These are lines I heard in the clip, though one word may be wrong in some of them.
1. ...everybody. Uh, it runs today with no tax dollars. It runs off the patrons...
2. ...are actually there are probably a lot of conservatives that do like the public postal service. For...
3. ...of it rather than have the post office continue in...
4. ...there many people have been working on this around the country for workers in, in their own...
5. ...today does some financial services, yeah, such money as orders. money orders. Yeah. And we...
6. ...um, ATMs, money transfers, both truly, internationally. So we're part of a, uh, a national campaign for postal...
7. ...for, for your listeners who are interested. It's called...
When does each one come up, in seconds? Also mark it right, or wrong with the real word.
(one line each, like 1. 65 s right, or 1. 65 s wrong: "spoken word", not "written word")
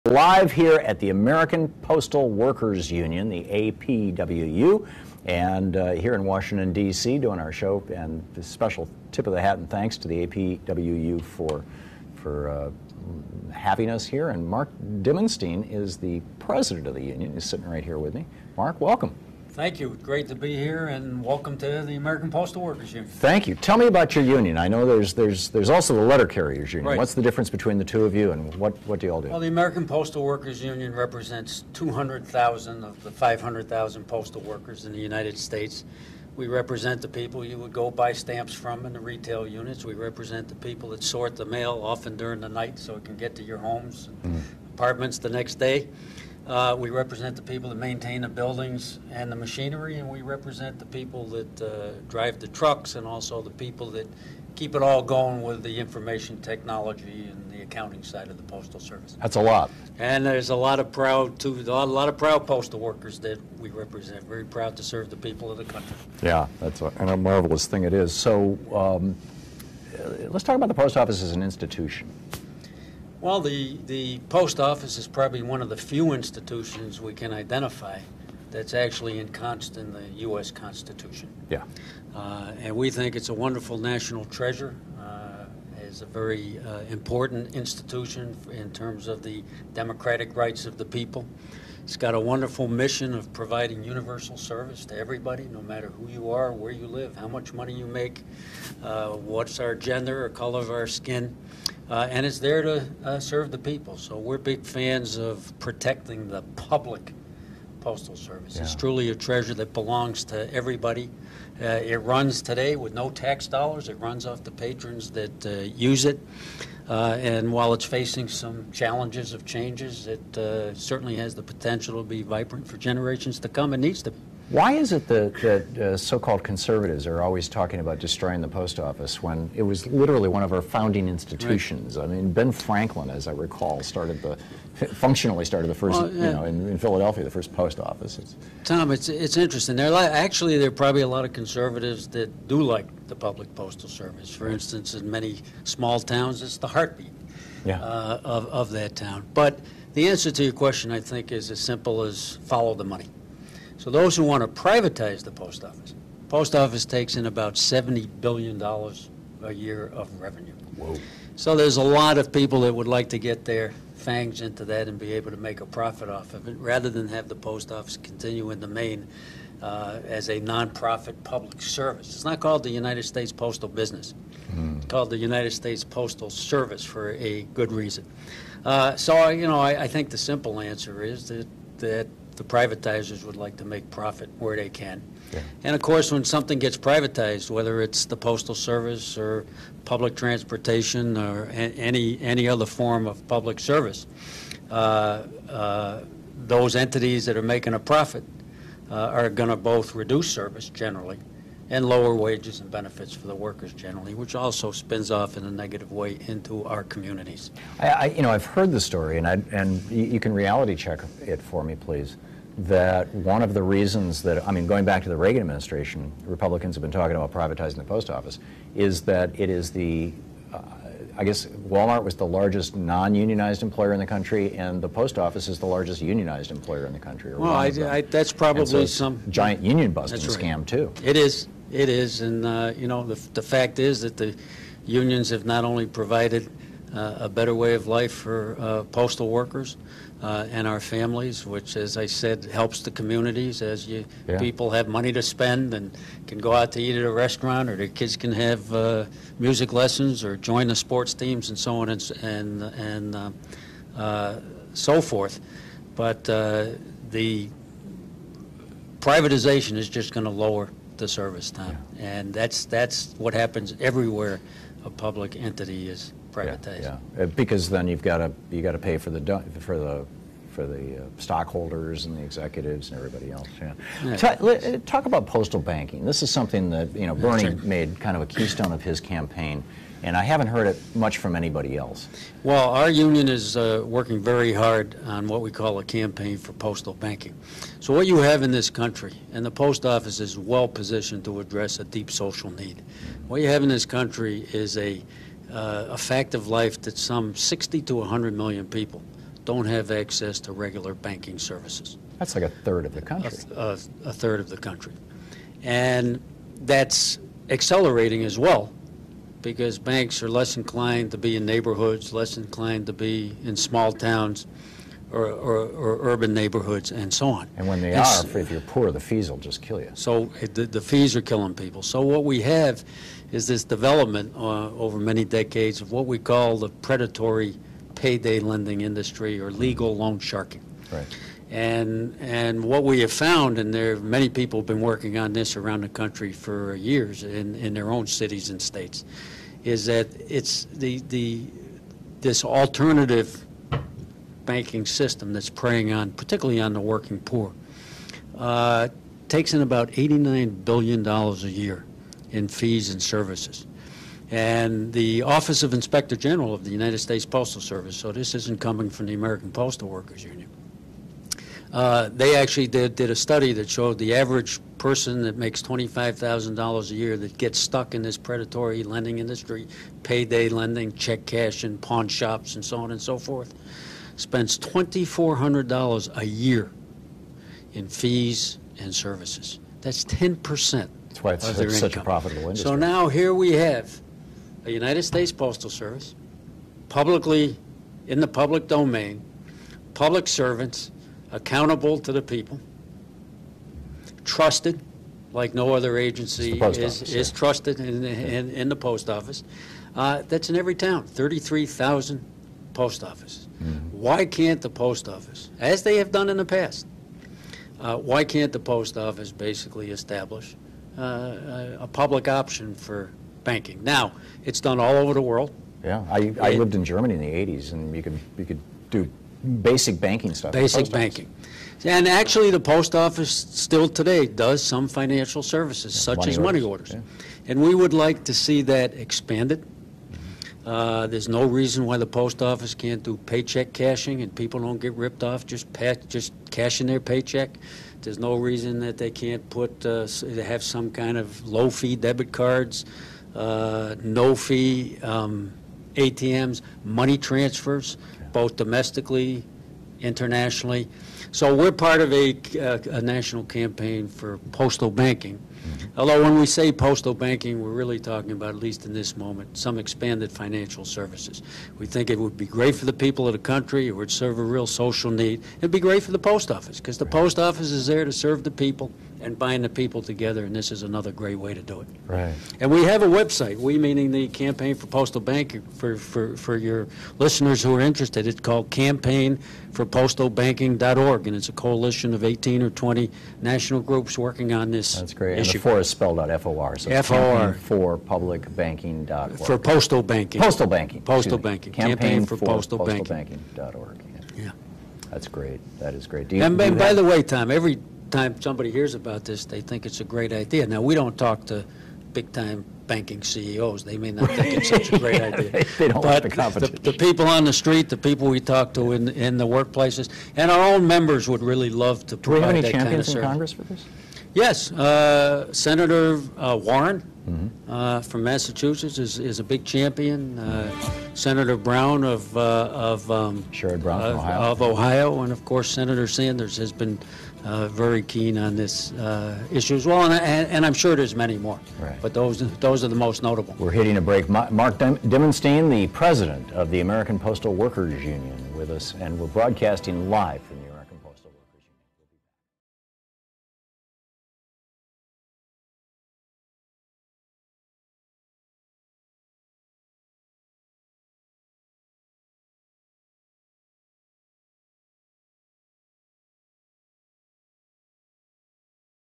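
1. 110 s right
2. 139 s right
3. 166 s right
4. 333 s wrong: "years", not "workers"
5. 423 s right
6. 445 s wrong: "domestically", not "truly"
7. 475 s right.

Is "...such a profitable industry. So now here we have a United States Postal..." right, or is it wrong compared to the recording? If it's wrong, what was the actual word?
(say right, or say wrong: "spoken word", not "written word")
right.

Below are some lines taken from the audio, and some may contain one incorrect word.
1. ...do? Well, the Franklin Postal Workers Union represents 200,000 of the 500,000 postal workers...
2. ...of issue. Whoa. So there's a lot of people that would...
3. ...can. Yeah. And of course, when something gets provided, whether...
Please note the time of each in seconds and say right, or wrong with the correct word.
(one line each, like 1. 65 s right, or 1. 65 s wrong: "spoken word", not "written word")
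1. 29 s wrong: "American", not "Franklin"
2. 159 s wrong: "revenue", not "issue"
3. 184 s wrong: "privatized", not "provided".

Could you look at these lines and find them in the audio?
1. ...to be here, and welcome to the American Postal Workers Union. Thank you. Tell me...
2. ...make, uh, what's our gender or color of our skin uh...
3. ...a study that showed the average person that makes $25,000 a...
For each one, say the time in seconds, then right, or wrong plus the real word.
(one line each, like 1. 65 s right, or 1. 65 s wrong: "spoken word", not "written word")
1. 20 s right
2. 97 s right
3. 363 s right.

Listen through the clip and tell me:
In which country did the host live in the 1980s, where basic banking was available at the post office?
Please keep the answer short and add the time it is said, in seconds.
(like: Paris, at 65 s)
Germany, at 416 s.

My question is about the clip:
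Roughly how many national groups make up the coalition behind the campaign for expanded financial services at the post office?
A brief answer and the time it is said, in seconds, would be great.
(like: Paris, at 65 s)
18 or 20, at 482 s.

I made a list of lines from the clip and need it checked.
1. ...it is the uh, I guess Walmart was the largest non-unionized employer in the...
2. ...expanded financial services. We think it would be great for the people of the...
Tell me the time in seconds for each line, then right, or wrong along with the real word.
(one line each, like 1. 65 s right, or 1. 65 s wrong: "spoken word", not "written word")
1. 219 s right
2. 459 s right.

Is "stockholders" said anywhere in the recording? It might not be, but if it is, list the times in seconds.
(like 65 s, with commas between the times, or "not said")
271 s.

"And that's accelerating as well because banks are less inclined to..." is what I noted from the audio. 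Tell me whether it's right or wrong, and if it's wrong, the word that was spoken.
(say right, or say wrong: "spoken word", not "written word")
right.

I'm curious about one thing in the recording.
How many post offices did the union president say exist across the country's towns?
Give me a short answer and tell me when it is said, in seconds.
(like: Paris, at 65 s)
33,000, at 401 s.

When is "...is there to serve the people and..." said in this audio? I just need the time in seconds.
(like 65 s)
467 s.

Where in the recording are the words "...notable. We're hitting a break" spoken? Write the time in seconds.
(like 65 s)
533 s.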